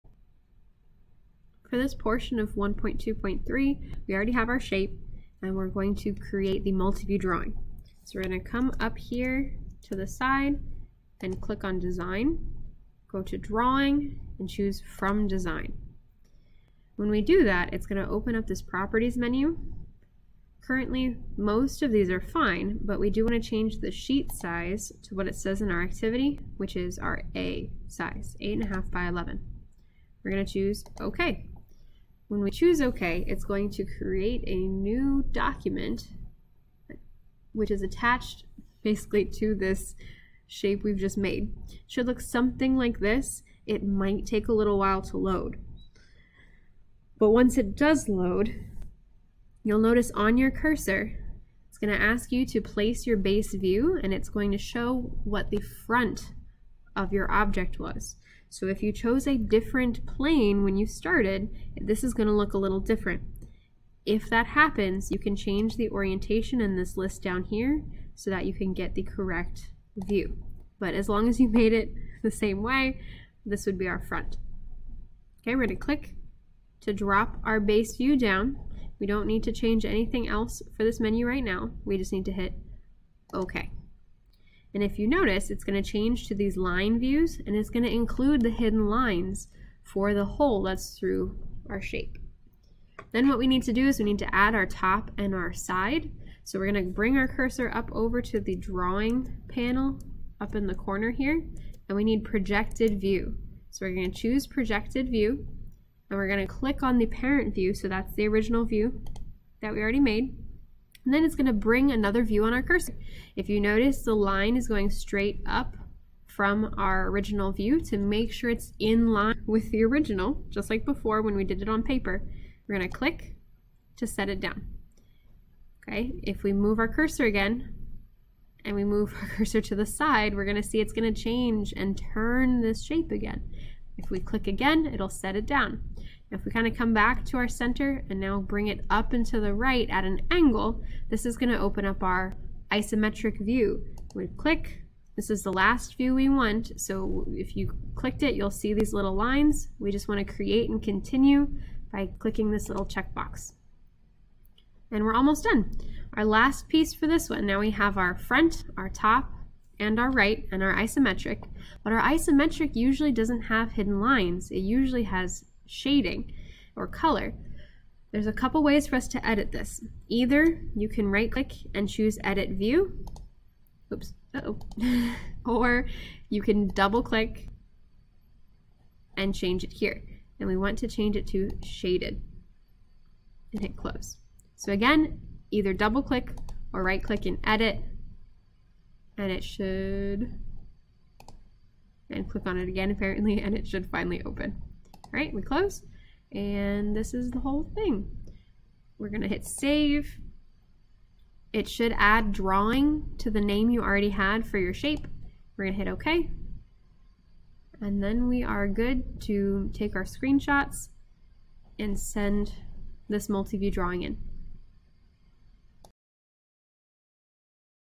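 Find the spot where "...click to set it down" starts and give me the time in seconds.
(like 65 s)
122 s.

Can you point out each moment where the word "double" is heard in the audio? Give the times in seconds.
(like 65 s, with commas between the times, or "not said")
176 s, 185 s.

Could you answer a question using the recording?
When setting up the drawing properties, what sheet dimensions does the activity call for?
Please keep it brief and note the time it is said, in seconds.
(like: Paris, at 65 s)
8.5 by 11, at 28 s.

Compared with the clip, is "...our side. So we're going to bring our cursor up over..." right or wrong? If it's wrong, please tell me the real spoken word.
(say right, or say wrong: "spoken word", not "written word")
right.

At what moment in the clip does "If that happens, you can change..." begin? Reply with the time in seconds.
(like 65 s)
64 s.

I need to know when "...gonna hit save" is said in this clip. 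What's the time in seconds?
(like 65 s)
199 s.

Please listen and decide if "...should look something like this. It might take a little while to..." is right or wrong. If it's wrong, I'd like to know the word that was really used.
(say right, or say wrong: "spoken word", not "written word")
right.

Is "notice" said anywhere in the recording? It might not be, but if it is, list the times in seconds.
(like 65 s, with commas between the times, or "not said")
49 s, 85 s, 113 s.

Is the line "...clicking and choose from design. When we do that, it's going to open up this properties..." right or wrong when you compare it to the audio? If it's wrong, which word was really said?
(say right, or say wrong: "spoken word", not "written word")
wrong: "drawing", not "clicking".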